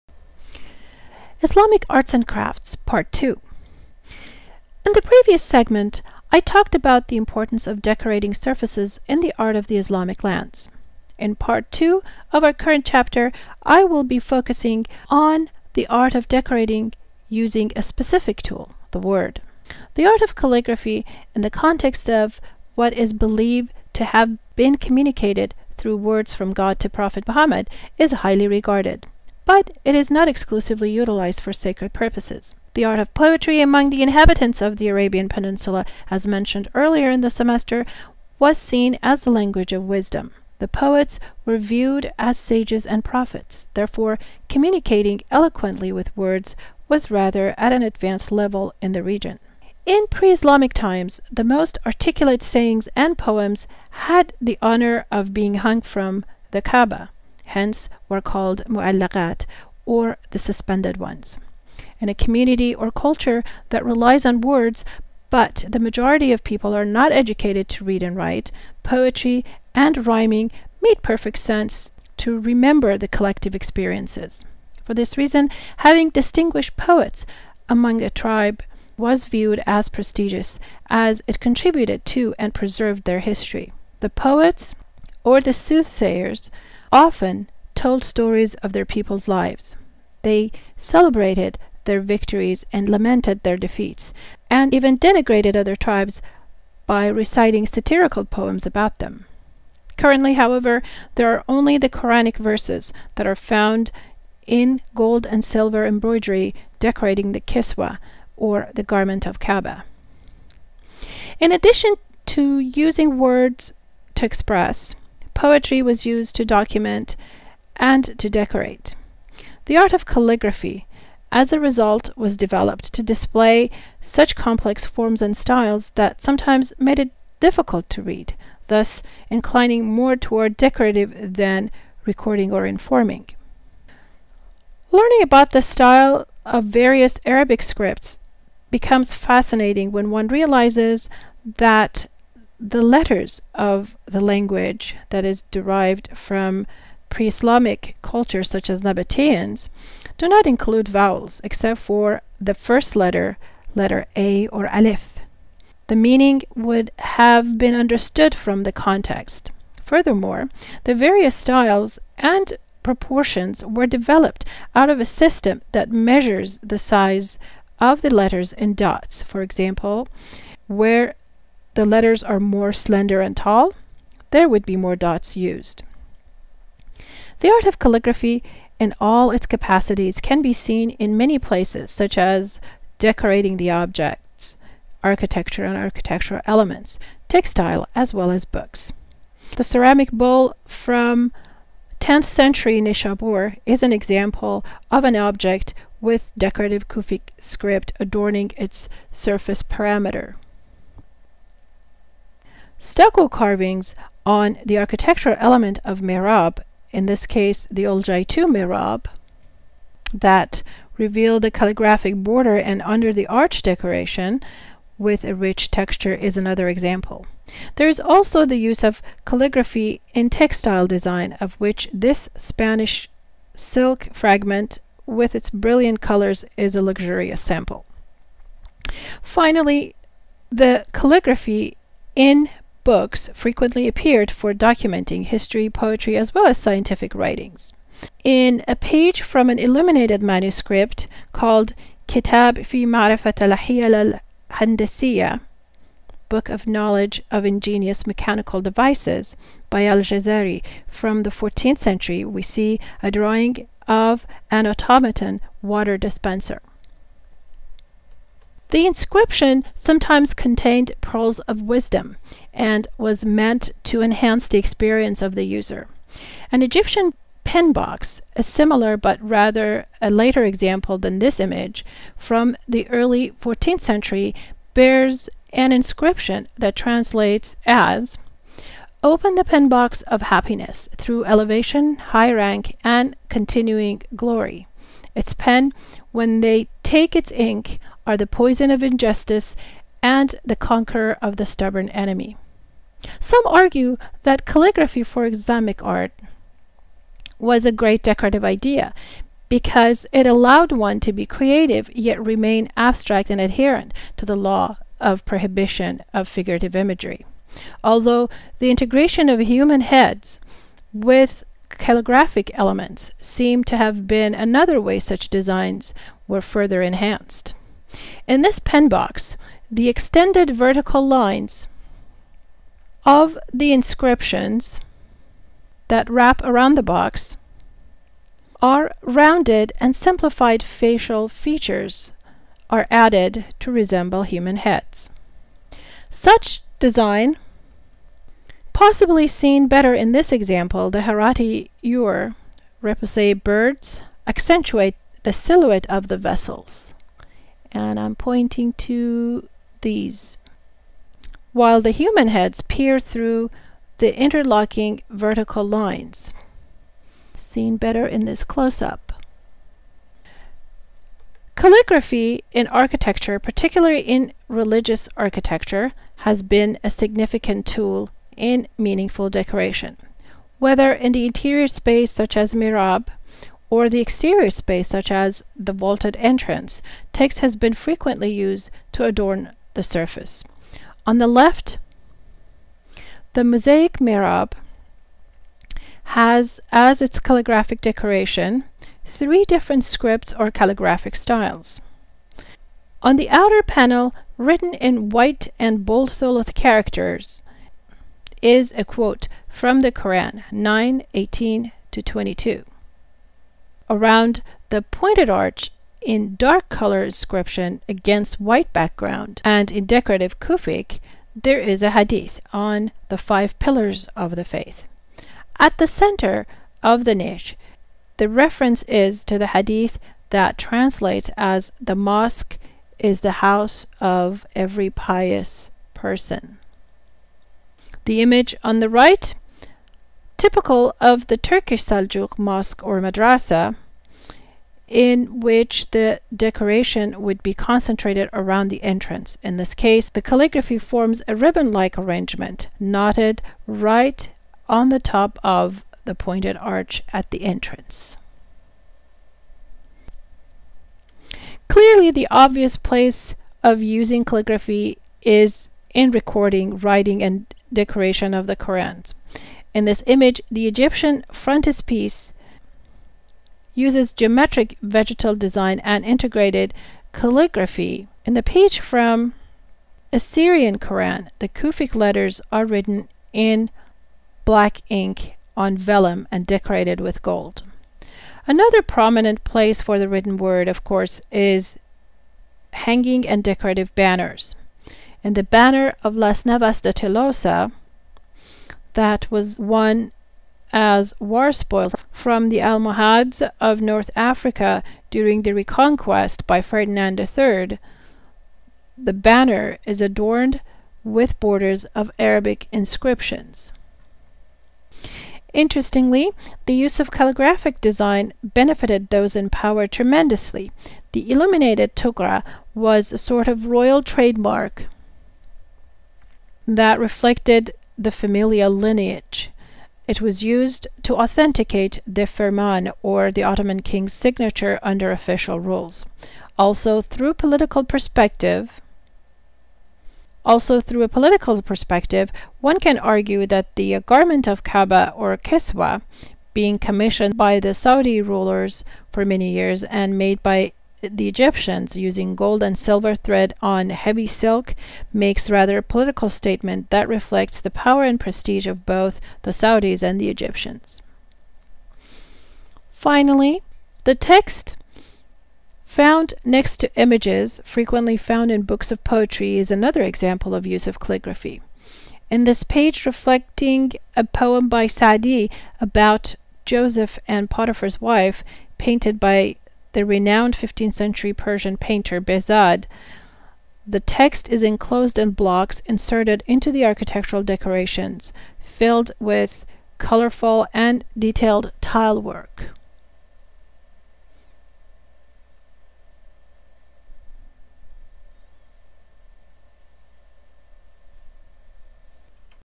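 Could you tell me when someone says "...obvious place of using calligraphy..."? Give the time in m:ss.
7:32.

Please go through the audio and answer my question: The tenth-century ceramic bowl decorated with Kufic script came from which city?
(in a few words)
Nishabur.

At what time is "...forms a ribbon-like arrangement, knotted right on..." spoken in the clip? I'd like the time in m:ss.
7:20.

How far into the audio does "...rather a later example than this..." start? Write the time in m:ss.
4:29.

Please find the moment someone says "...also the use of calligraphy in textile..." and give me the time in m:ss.
3:37.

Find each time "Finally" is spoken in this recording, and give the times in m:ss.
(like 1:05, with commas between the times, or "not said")
3:49, 9:12.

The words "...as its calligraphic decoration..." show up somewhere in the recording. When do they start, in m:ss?
6:26.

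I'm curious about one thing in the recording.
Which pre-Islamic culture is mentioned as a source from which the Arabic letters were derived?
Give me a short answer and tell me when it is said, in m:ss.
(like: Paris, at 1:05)
Nabateans, at 2:28.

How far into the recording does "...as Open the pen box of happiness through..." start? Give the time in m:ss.
4:37.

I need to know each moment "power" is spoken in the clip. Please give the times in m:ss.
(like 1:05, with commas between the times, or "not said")
8:29, 9:07.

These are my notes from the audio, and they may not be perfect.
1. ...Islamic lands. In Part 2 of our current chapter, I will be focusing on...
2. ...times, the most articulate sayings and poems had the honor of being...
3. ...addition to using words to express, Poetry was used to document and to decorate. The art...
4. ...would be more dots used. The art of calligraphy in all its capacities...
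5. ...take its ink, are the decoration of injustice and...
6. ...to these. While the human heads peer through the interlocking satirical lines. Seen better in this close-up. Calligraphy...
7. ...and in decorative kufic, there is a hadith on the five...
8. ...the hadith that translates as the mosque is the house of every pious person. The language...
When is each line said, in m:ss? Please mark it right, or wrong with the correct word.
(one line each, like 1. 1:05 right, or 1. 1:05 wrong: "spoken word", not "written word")
1. 0:09 right
2. 0:50 right
3. 1:51 right
4. 2:54 right
5. 4:46 wrong: "poison", not "decoration"
6. 5:48 wrong: "vertical", not "satirical"
7. 6:49 right
8. 6:59 wrong: "image", not "language".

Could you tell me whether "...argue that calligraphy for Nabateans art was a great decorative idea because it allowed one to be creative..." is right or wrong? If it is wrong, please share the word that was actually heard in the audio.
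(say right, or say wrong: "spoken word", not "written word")
wrong: "Islamic", not "Nabateans".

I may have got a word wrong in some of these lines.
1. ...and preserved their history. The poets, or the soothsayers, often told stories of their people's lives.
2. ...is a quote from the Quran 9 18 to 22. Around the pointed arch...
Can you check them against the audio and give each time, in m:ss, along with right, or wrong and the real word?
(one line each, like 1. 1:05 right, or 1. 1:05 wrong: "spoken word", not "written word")
1. 1:22 right
2. 6:38 right.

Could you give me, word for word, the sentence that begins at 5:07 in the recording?
Although the integration of human heads with calligraphic elements seem to have been another way such designs were further enhanced.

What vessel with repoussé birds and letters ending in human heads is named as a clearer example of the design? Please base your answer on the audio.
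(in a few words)
Herati ewer.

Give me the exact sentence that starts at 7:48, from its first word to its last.
In the page from Assyrian Koran, the Kufic letters are written in black ink on vellum and decorated with gold.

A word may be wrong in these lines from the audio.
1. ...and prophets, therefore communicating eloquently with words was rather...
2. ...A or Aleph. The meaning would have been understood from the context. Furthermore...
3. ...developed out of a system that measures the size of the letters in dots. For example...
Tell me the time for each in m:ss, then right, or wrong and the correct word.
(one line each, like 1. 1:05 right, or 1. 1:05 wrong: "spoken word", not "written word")
1. 0:42 right
2. 2:34 right
3. 2:43 right.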